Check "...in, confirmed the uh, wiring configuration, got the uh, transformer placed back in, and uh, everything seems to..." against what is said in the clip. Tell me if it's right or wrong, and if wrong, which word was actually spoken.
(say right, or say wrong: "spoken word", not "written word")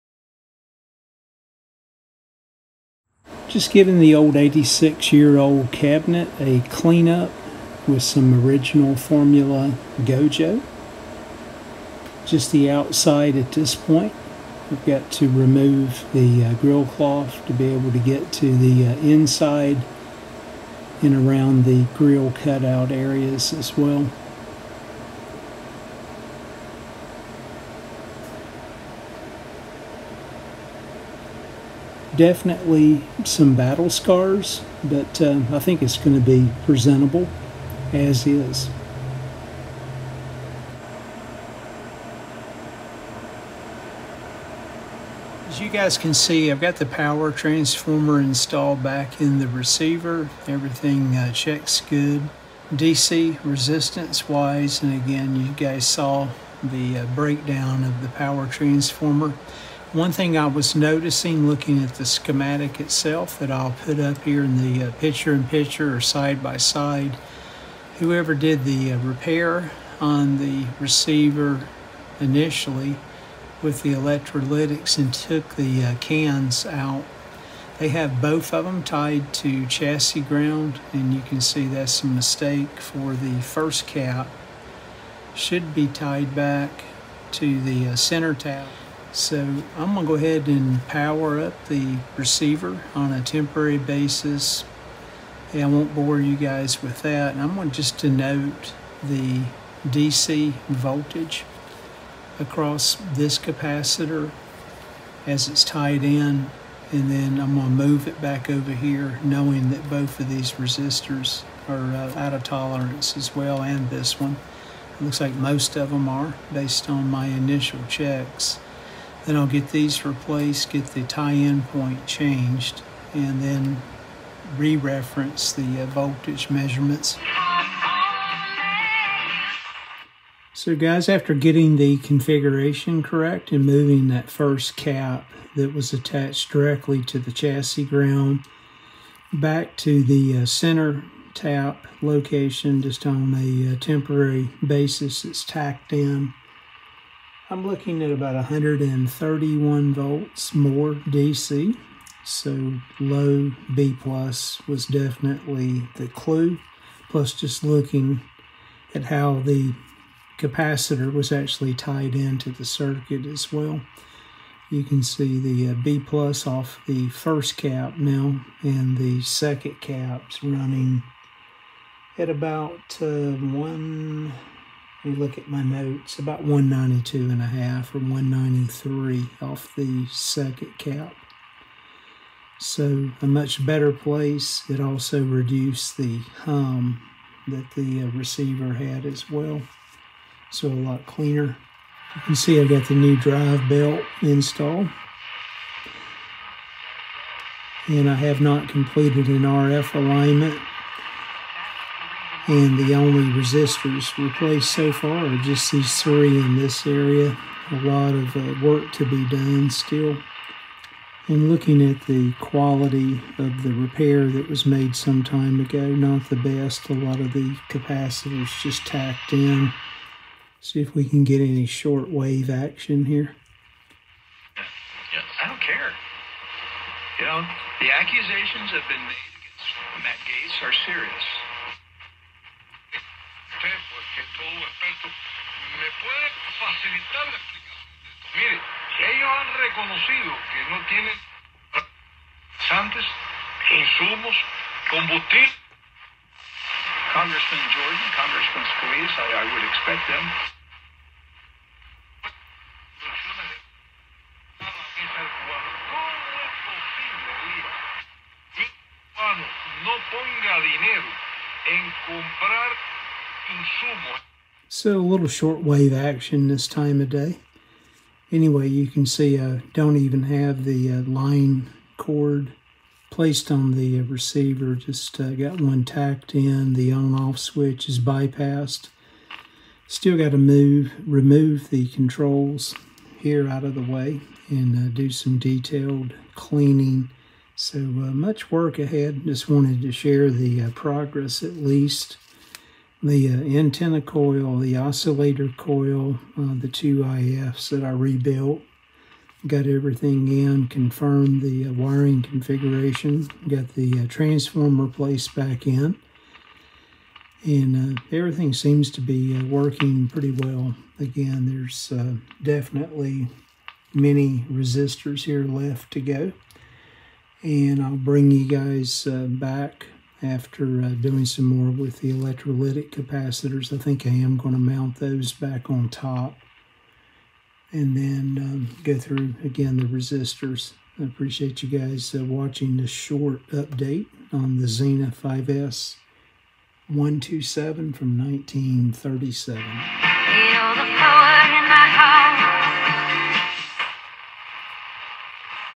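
right.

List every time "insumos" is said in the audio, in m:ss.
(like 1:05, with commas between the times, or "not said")
4:03, 4:23.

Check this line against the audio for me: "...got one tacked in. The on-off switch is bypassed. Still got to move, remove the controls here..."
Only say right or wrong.
right.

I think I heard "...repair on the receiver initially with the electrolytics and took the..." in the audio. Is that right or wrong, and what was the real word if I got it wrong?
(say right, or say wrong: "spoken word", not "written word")
right.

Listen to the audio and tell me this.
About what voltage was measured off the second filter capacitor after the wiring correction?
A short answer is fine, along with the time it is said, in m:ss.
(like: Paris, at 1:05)
193, at 2:57.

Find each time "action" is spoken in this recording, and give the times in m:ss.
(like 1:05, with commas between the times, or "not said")
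3:42, 4:25.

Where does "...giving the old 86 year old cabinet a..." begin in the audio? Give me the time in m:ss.
0:03.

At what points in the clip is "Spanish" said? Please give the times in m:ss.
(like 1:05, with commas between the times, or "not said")
not said.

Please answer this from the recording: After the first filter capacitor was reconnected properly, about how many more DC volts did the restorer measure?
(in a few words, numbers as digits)
131 volts.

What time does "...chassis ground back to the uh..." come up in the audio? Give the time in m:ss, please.
2:17.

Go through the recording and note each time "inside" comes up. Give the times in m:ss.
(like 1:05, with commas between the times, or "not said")
0:18.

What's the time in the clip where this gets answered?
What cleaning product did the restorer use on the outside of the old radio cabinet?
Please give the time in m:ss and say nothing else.
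0:09.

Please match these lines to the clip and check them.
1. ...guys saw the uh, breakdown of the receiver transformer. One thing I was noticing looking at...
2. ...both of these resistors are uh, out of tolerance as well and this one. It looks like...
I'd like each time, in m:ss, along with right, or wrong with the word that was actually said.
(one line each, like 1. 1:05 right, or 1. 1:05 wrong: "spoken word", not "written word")
1. 0:55 wrong: "power", not "receiver"
2. 1:49 right.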